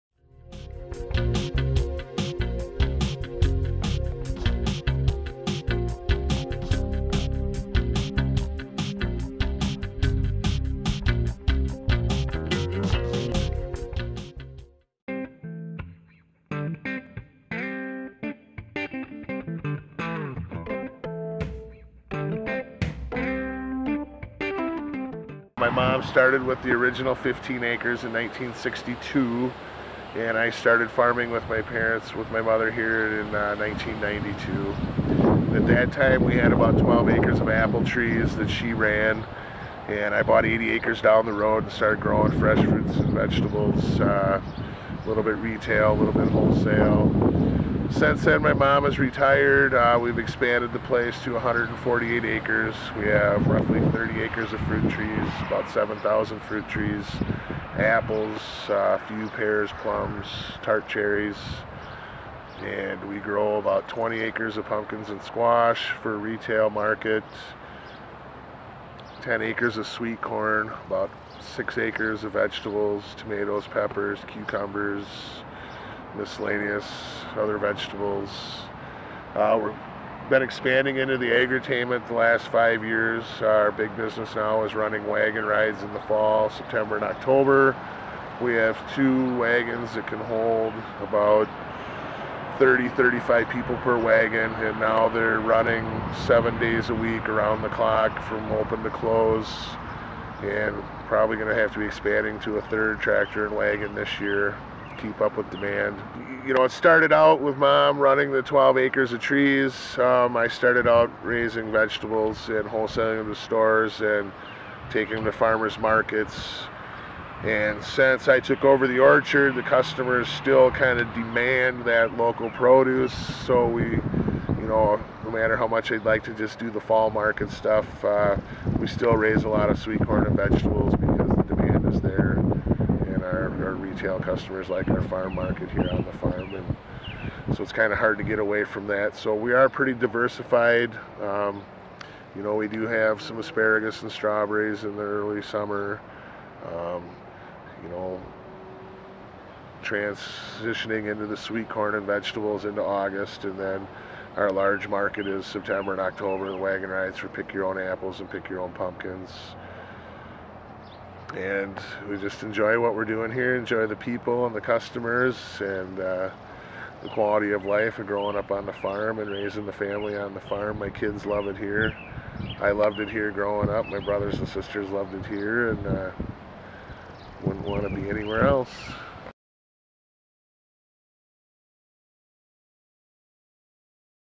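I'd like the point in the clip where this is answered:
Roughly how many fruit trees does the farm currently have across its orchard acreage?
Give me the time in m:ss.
0:55.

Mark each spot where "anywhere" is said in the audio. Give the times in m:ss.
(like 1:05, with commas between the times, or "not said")
2:58.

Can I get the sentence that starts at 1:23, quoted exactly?
Our big business now is running wagon rides in the fall, September and October.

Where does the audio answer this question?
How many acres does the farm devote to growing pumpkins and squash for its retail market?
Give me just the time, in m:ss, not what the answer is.
1:03.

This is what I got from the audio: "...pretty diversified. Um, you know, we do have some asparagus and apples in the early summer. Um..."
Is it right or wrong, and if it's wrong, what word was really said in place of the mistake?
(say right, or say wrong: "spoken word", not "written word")
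wrong: "strawberries", not "apples".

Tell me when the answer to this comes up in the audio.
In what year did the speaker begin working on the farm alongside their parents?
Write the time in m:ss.
0:33.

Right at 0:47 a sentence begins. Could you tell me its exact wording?
Since then, my mom has retired.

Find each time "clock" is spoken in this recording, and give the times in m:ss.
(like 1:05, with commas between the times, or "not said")
1:37.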